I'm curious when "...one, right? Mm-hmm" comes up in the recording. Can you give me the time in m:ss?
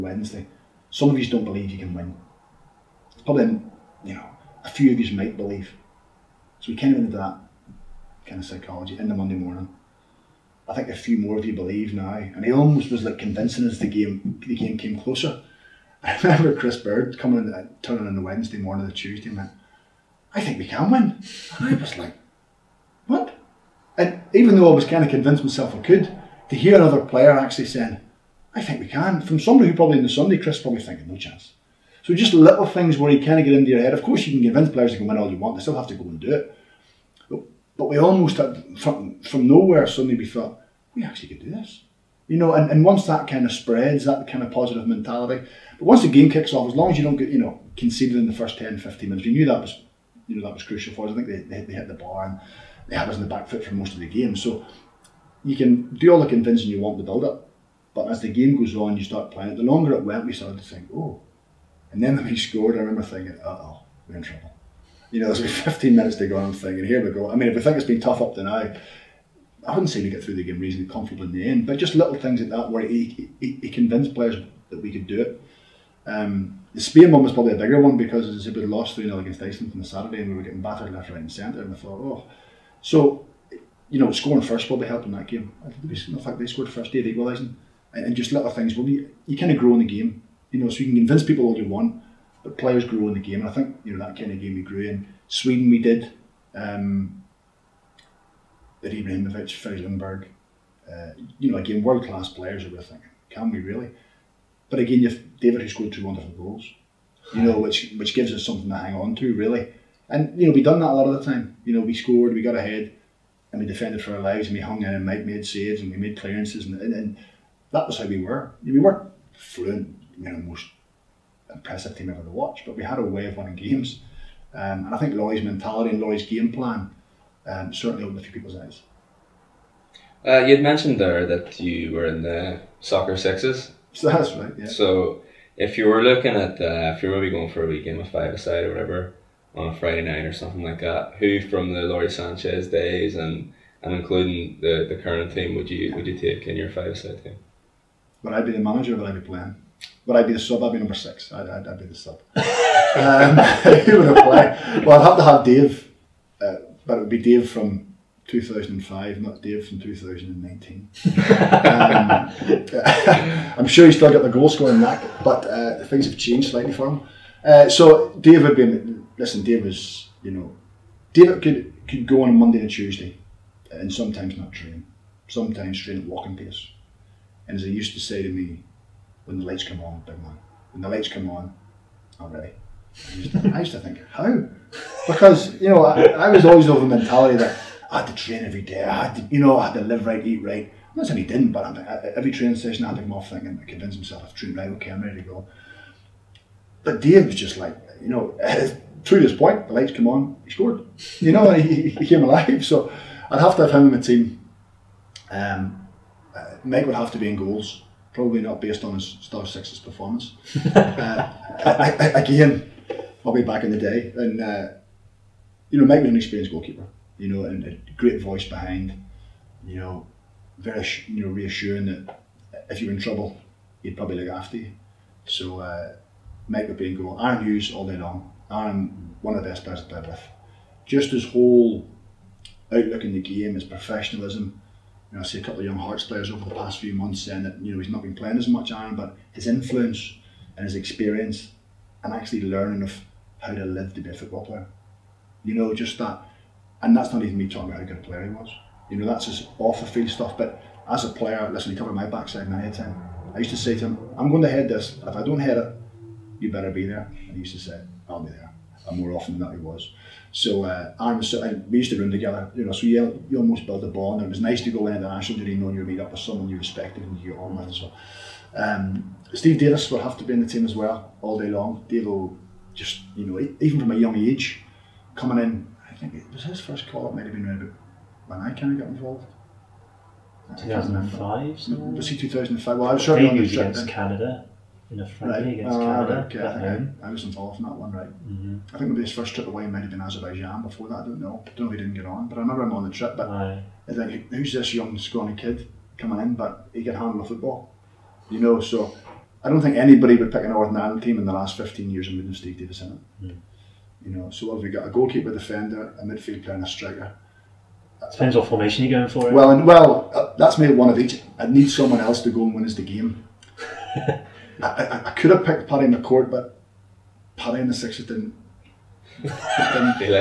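4:47.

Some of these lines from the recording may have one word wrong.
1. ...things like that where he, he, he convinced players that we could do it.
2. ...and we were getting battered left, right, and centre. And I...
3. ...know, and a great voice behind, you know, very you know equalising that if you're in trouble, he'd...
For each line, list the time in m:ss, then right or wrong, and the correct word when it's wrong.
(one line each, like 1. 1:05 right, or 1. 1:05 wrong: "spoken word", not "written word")
1. 1:12 right
2. 1:20 right
3. 3:37 wrong: "reassuring", not "equalising".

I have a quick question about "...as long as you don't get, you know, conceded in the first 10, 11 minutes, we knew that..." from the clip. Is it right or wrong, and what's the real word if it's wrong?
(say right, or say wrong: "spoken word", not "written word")
wrong: "15", not "11".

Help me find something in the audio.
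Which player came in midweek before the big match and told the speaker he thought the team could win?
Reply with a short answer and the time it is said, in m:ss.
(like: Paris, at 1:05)
Chris Baird, at 0:16.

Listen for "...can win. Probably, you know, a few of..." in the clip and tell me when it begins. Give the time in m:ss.
0:01.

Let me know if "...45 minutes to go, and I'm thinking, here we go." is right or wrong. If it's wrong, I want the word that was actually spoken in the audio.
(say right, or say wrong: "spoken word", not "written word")
wrong: "15", not "45".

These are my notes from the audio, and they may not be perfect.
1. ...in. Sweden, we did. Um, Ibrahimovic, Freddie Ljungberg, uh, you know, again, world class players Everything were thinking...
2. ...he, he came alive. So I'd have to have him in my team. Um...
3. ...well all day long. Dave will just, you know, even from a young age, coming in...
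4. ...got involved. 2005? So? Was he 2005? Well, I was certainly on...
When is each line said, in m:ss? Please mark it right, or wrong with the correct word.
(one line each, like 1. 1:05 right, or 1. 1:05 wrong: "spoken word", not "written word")
1. 1:34 right
2. 3:21 right
3. 4:30 right
4. 4:38 right.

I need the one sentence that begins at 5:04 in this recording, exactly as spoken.
A goalkeeper, defender, a midfield player, and a striker.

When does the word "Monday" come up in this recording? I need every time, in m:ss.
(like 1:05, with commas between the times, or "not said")
0:09, 2:52.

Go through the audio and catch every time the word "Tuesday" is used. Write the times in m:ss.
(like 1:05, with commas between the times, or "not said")
0:18, 2:52.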